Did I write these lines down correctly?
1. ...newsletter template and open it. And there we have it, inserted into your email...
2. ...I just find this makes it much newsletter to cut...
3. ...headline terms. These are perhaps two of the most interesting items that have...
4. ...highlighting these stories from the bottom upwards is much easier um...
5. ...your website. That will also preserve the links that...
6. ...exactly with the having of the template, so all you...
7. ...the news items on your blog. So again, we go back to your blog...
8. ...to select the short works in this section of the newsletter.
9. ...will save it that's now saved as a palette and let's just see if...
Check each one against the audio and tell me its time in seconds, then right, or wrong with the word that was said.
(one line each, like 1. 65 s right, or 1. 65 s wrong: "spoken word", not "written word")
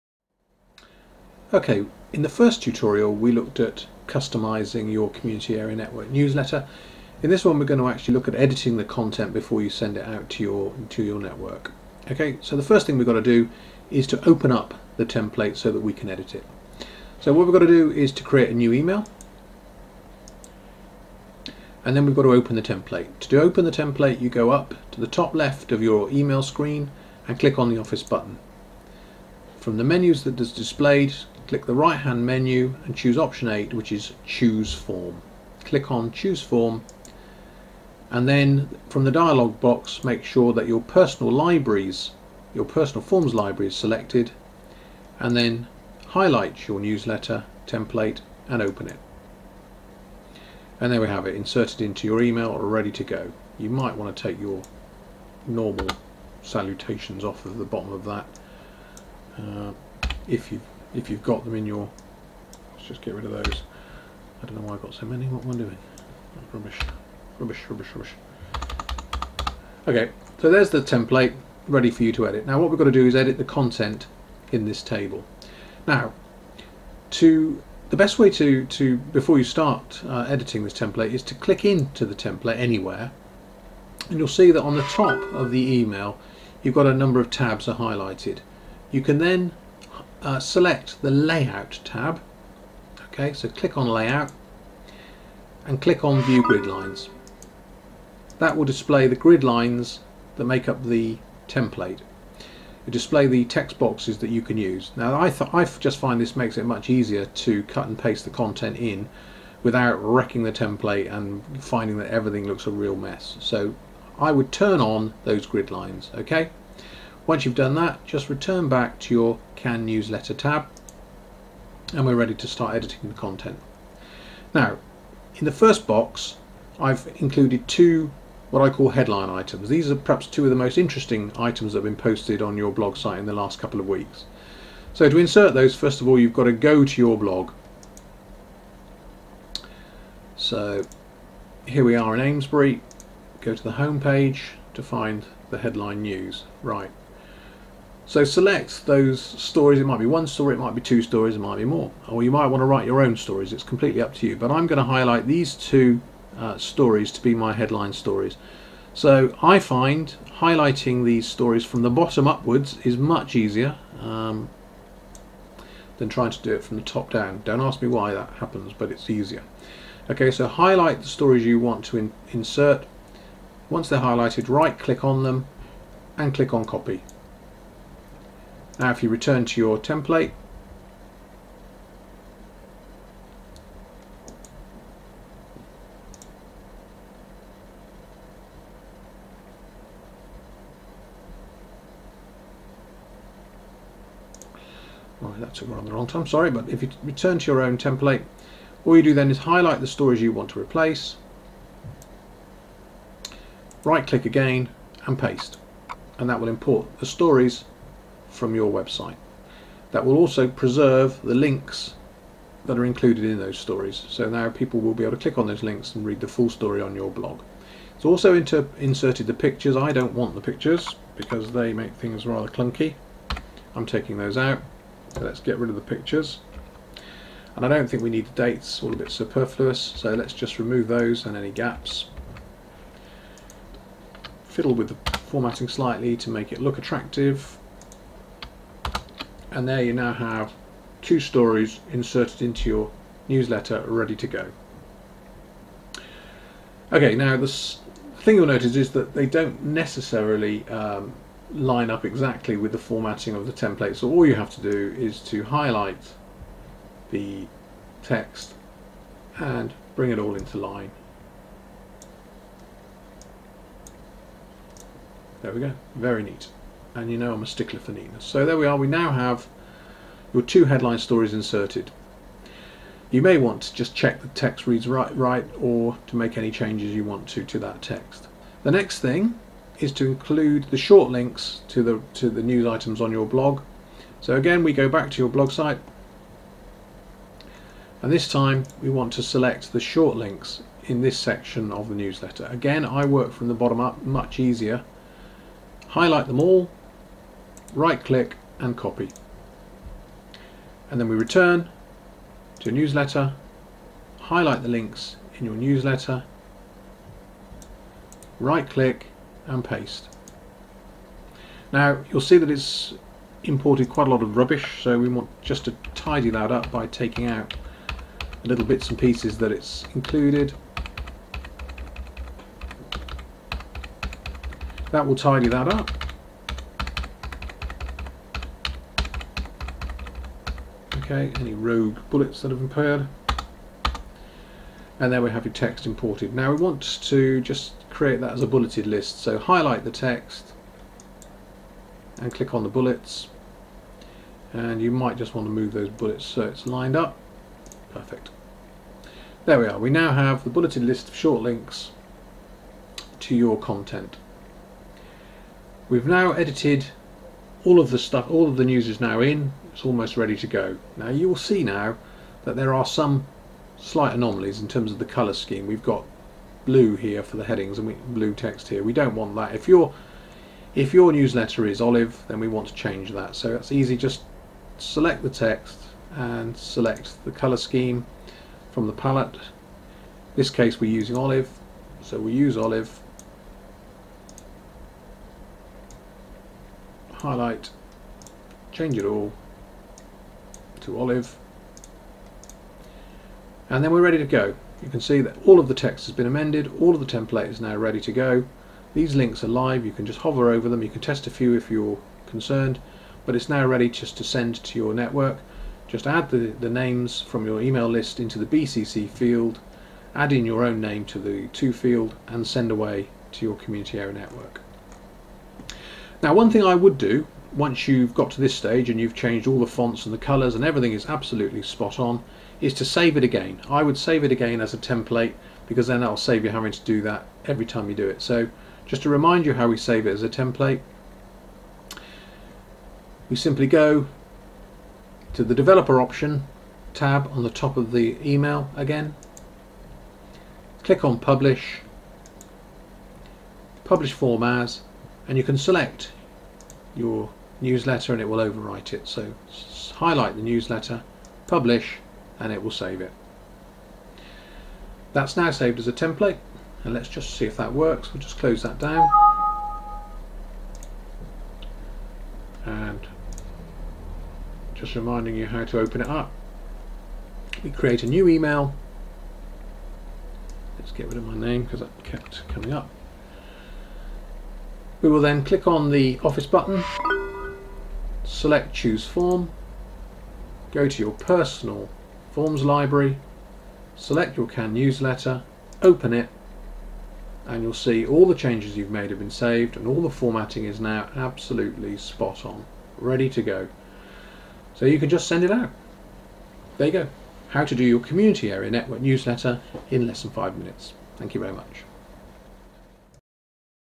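1. 46 s right
2. 105 s wrong: "easier", not "newsletter"
3. 128 s wrong: "items", not "terms"
4. 160 s right
5. 208 s right
6. 252 s wrong: "formatting", not "having"
7. 282 s right
8. 289 s wrong: "links", not "works"
9. 452 s wrong: "template", not "palette".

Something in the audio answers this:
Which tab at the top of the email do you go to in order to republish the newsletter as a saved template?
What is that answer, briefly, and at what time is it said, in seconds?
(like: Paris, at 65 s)
Developer, at 435 s.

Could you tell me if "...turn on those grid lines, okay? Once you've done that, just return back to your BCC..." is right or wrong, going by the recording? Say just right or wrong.
wrong.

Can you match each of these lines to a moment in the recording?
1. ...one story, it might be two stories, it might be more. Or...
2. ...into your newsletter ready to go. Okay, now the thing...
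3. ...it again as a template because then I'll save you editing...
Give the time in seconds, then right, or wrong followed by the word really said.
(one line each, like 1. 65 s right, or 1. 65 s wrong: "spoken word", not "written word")
1. 150 s right
2. 242 s right
3. 424 s wrong: "having", not "editing".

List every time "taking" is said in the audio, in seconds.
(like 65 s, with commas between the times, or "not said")
223 s, 316 s.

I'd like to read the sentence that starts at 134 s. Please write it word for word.
So to insert those, first of all, you've got to go to your blog.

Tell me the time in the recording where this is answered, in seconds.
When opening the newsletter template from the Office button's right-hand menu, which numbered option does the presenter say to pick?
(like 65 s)
33 s.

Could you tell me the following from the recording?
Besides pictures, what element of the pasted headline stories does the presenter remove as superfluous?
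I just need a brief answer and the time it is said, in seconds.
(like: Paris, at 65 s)
The dates, at 228 s.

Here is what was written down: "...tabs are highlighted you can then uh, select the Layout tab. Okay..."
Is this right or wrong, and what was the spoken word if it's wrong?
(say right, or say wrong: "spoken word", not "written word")
right.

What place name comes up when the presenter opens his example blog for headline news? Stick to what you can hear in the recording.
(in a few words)
Amesbury.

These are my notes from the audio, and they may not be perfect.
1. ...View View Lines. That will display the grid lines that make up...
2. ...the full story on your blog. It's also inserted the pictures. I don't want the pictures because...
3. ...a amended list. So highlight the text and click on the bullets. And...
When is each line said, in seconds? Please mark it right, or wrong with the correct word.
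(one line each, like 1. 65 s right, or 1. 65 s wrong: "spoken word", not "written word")
1. 96 s wrong: "Grid", not "View"
2. 216 s right
3. 338 s wrong: "bulleted", not "amended".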